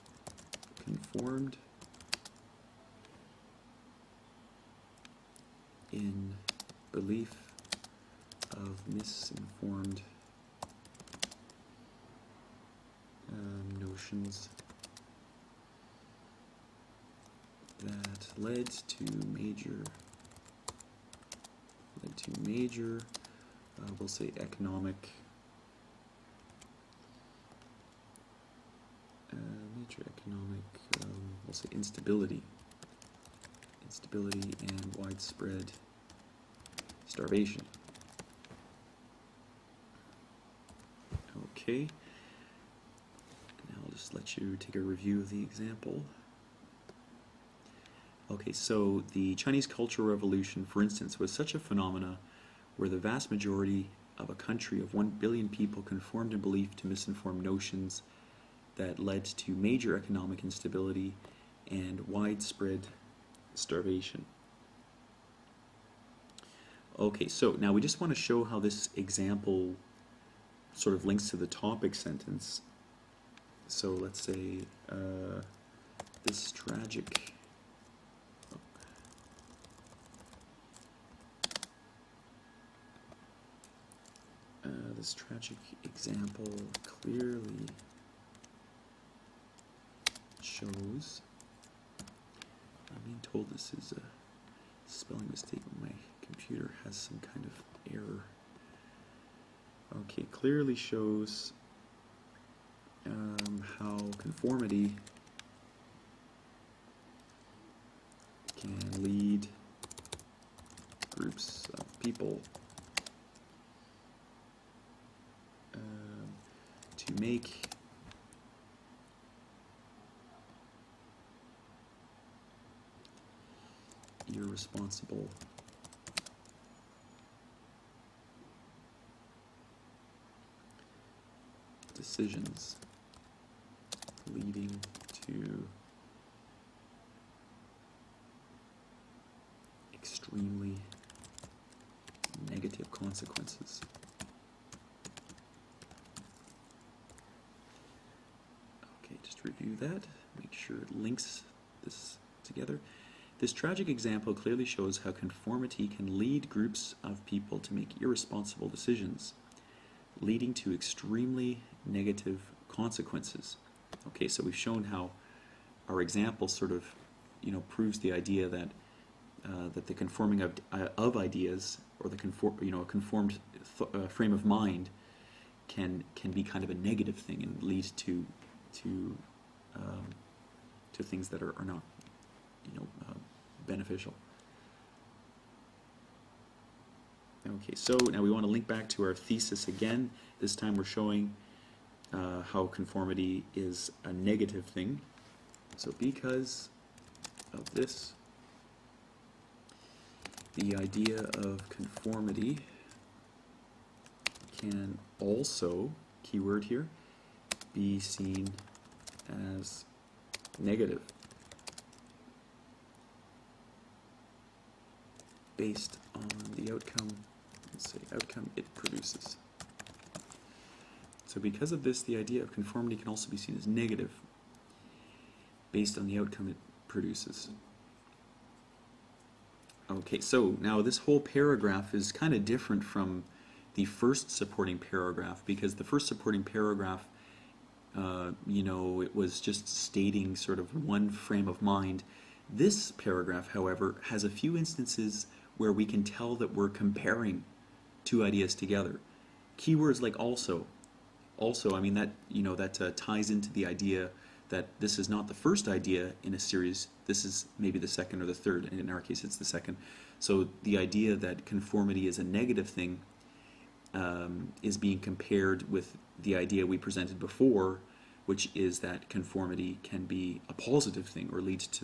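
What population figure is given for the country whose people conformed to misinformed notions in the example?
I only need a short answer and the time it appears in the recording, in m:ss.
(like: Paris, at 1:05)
1 billion, at 0:54.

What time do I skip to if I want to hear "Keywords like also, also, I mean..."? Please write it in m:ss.
4:09.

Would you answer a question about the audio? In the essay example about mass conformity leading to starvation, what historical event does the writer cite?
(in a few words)
Chinese Cultural Revolution.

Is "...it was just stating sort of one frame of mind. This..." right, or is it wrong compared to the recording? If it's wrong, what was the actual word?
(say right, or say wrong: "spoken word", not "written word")
right.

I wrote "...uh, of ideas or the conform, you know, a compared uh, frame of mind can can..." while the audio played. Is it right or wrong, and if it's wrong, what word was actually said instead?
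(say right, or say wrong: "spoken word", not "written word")
wrong: "conformed", not "compared".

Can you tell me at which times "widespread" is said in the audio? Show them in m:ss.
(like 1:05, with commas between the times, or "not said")
0:34, 1:02.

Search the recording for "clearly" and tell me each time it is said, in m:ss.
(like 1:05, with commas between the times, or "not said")
1:27, 1:40, 2:34.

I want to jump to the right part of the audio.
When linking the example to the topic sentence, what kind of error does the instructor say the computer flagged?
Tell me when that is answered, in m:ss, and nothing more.
1:34.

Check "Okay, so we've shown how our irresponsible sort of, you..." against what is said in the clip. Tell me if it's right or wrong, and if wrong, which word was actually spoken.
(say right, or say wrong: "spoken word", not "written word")
wrong: "example", not "irresponsible".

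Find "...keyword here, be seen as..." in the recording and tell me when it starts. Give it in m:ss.
3:26.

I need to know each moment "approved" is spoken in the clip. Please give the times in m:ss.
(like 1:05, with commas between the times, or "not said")
not said.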